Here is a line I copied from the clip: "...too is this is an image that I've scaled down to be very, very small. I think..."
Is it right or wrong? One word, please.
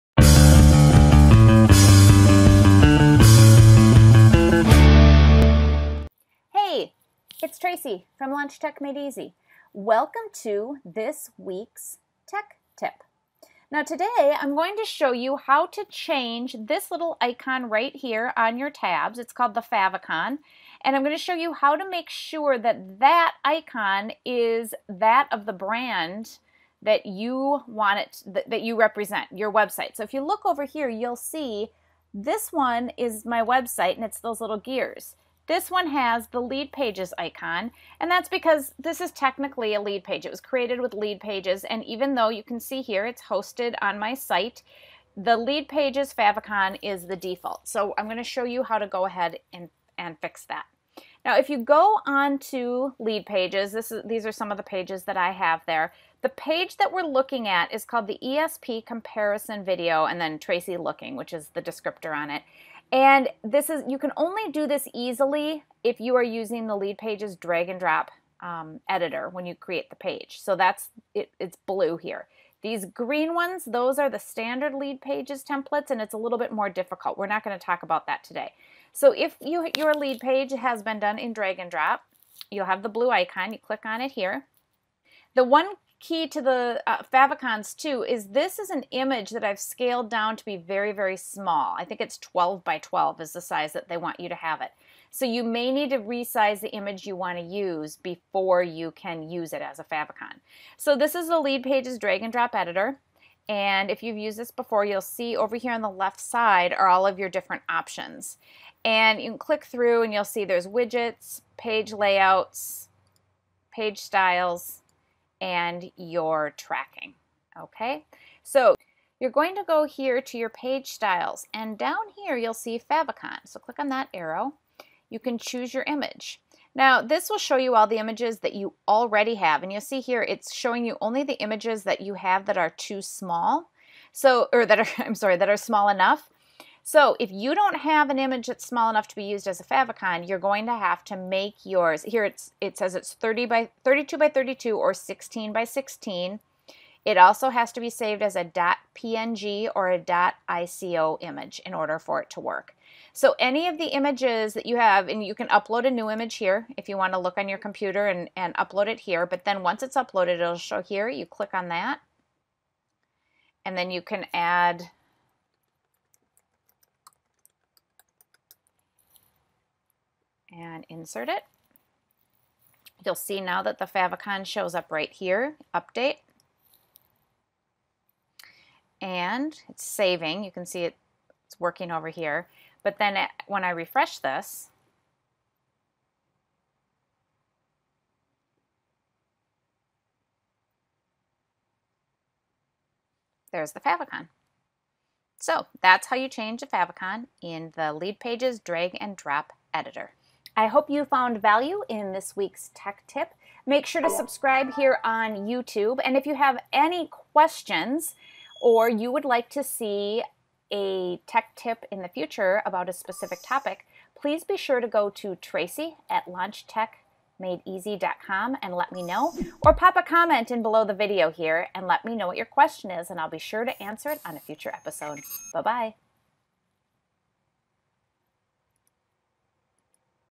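right.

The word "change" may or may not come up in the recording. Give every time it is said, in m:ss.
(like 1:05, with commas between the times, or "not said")
0:15, 3:16.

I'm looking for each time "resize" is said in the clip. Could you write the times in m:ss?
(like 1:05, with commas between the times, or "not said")
1:35.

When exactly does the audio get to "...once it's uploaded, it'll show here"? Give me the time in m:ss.
2:39.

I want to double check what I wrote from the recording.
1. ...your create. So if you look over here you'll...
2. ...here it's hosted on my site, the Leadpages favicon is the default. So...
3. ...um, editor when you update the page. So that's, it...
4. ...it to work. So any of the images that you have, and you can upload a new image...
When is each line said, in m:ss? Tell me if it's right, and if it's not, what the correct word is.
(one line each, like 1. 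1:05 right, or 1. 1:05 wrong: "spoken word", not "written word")
1. 0:29 wrong: "website", not "create"
2. 0:42 right
3. 1:08 wrong: "create", not "update"
4. 2:32 right.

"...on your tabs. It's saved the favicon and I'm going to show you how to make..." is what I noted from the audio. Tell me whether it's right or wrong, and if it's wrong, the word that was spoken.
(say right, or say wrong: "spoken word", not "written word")
wrong: "called", not "saved".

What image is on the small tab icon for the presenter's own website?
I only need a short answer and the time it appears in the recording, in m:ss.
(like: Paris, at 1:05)
Gears, at 0:34.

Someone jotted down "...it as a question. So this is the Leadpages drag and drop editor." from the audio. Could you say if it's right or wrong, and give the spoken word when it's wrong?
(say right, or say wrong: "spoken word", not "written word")
wrong: "favicon", not "question".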